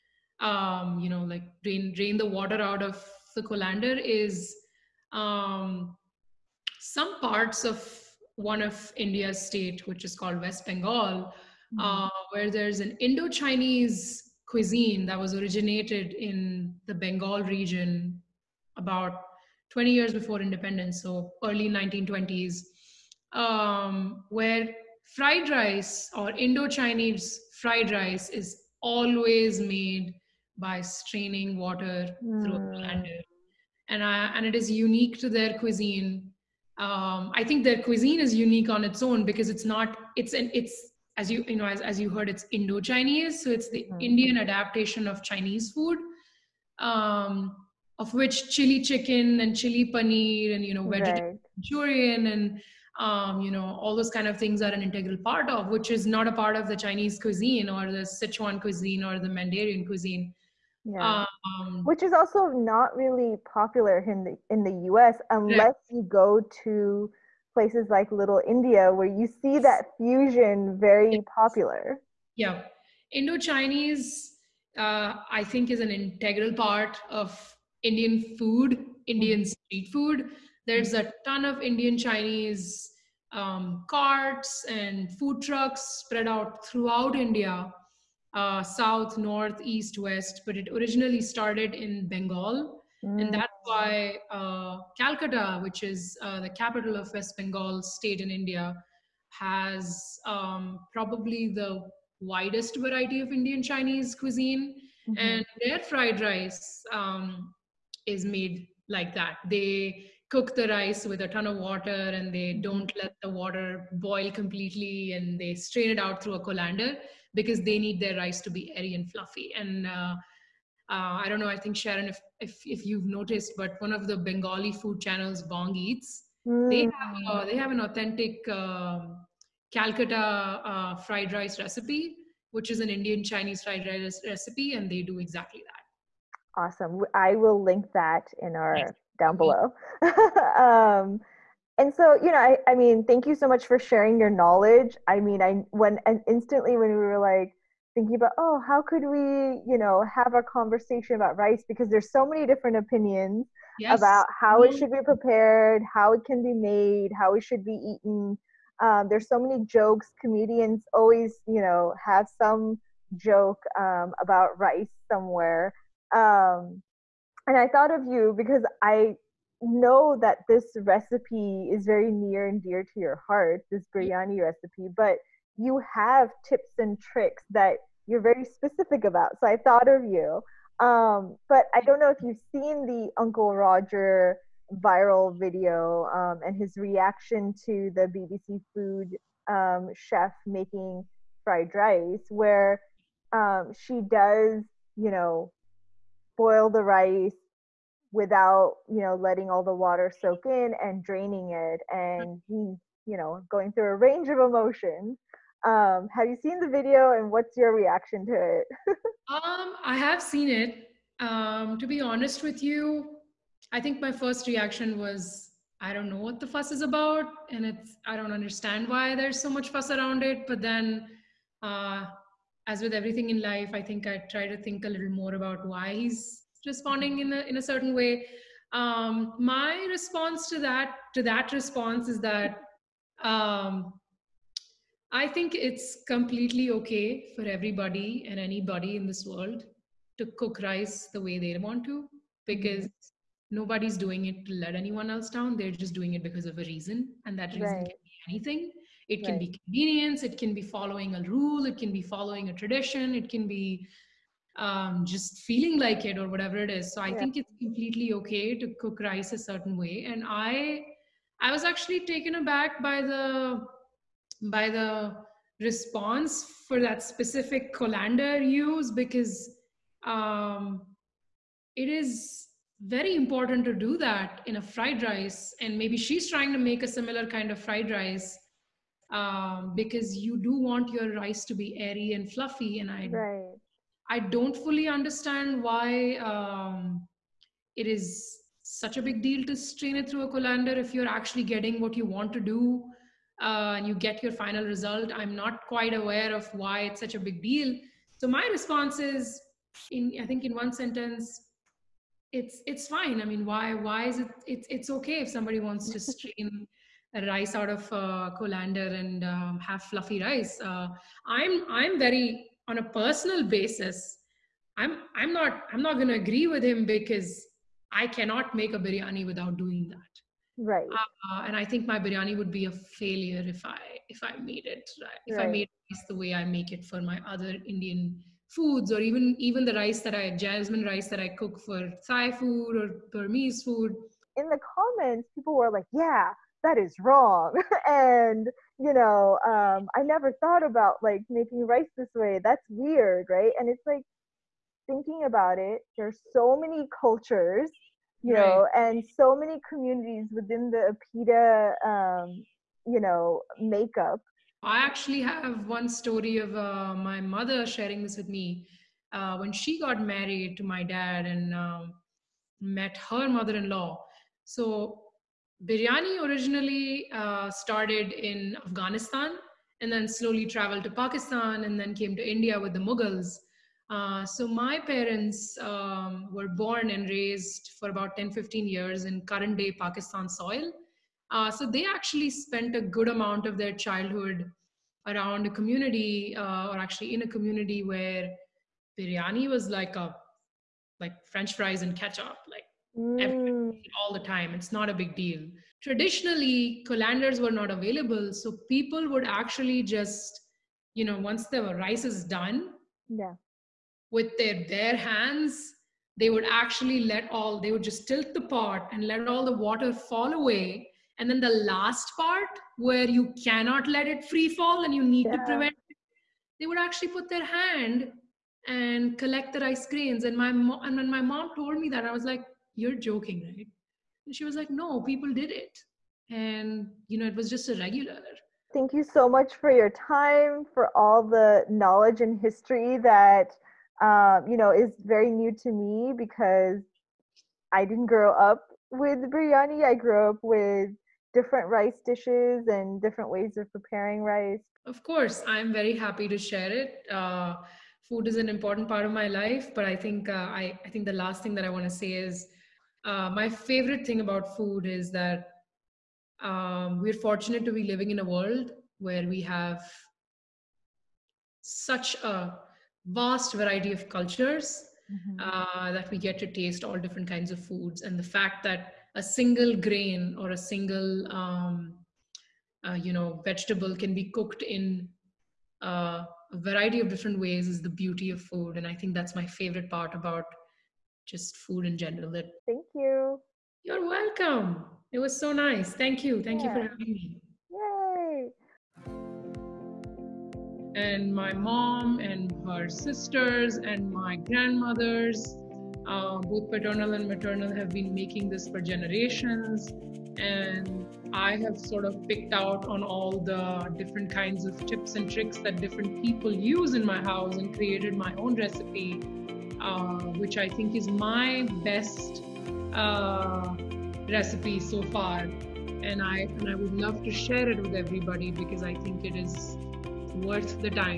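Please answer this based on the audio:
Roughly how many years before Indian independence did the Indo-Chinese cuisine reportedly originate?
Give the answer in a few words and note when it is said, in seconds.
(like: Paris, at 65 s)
20 years, at 18 s.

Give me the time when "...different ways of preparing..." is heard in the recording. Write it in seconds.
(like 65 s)
443 s.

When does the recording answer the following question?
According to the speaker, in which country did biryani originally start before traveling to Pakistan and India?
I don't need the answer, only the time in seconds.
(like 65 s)
368 s.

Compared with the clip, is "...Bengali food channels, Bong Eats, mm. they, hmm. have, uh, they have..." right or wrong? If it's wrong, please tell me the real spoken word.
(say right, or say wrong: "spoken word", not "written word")
right.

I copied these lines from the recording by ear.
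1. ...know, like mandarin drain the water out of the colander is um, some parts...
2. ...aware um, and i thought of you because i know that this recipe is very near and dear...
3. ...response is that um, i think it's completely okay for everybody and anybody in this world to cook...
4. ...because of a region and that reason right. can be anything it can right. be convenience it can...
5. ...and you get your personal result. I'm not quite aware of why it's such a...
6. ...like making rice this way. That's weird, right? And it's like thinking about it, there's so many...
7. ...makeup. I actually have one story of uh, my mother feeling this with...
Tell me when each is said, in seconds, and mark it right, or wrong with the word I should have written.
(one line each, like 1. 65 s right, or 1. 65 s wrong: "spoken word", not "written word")
1. 1 s wrong: "drain", not "mandarin"
2. 165 s wrong: "somewhere", not "aware"
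3. 231 s right
4. 246 s wrong: "reason", not "region"
5. 293 s wrong: "final", not "personal"
6. 341 s right
7. 353 s wrong: "sharing", not "feeling".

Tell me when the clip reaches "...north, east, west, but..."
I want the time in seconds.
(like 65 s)
89 s.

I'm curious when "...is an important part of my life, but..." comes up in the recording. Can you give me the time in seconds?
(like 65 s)
448 s.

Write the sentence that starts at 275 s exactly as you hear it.
And maybe she's trying to make a similar kind of fried rice.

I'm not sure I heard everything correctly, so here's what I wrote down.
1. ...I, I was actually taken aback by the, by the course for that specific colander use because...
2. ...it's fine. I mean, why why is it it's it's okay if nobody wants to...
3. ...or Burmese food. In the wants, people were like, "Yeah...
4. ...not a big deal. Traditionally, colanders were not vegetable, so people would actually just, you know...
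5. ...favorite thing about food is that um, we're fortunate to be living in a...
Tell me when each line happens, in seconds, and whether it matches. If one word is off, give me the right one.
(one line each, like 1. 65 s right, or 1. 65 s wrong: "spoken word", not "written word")
1. 260 s wrong: "response", not "course"
2. 302 s wrong: "somebody", not "nobody"
3. 332 s wrong: "comments", not "wants"
4. 394 s wrong: "available", not "vegetable"
5. 453 s right.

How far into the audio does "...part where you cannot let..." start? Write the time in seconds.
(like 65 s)
412 s.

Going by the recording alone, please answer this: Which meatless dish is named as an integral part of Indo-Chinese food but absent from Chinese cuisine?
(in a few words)
Chili paneer.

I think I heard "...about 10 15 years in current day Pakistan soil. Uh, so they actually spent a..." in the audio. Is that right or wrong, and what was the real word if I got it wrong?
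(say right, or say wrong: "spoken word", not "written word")
right.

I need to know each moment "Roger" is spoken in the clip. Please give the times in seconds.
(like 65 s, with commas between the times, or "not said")
183 s.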